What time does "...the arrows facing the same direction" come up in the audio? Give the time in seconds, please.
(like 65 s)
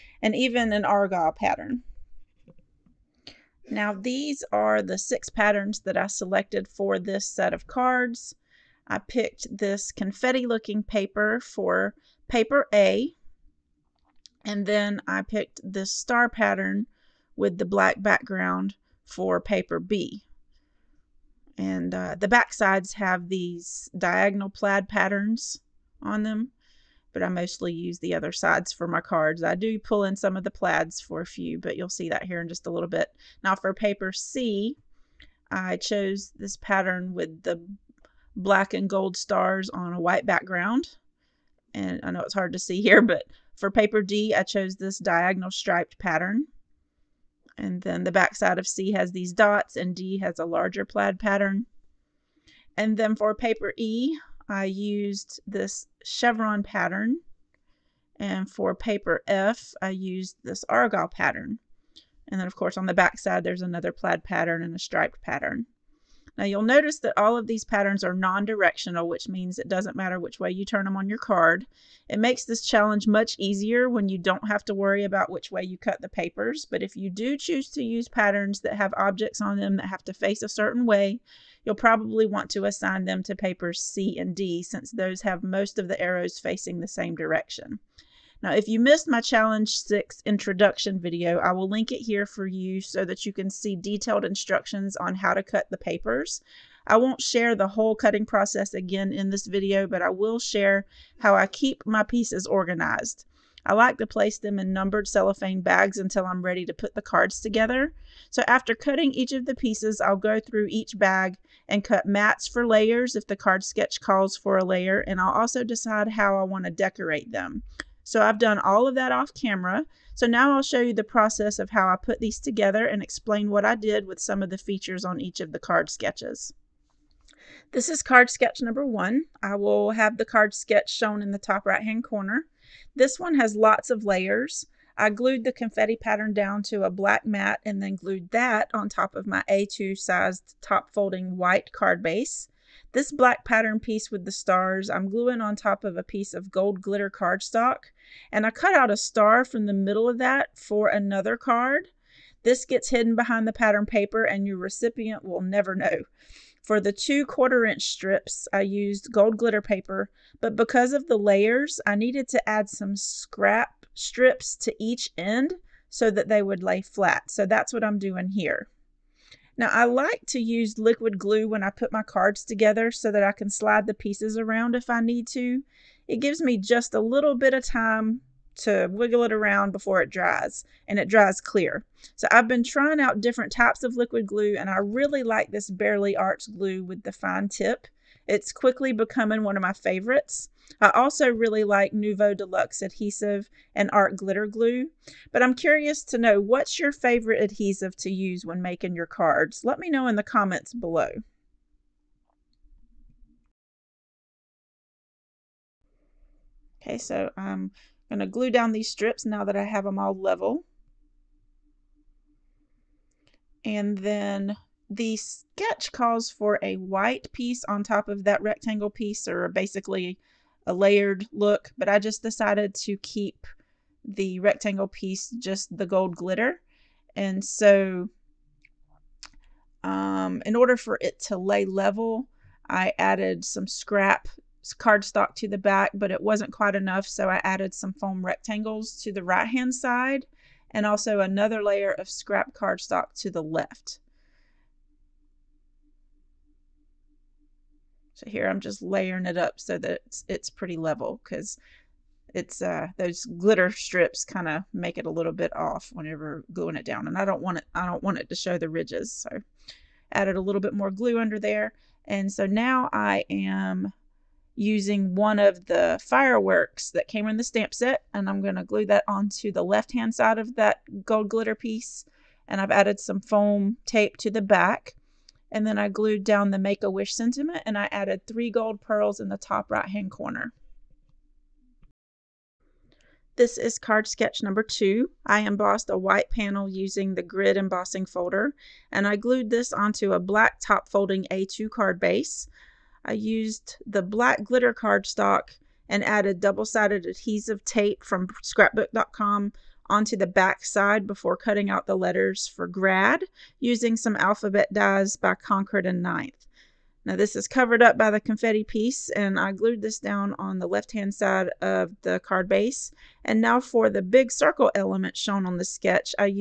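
85 s.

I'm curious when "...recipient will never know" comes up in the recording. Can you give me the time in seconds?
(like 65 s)
154 s.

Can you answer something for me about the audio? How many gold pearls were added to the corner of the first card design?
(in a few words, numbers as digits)
3.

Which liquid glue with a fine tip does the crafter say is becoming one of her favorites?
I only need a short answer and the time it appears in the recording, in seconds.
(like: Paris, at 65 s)
Bearly Arts glue, at 185 s.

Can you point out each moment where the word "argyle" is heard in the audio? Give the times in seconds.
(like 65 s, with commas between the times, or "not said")
0 s, 60 s.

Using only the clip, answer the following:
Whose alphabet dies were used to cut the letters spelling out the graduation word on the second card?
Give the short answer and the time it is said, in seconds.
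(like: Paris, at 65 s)
Concord and Ninth, at 305 s.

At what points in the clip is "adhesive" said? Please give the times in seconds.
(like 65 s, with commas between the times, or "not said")
192 s, 197 s, 297 s.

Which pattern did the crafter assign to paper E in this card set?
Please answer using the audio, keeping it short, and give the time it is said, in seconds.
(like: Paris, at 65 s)
Chevron, at 56 s.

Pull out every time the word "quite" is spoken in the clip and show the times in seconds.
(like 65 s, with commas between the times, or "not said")
236 s.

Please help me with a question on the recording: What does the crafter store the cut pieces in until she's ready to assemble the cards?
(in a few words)
Numbered cellophane bags.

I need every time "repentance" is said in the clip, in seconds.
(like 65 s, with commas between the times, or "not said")
not said.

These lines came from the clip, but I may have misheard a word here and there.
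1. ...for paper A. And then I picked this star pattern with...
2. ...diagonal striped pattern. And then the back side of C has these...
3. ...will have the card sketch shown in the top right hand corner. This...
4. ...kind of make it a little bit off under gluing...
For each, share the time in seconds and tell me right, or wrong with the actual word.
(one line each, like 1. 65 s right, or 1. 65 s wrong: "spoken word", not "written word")
1. 11 s right
2. 44 s right
3. 129 s right
4. 254 s wrong: "whenever", not "under".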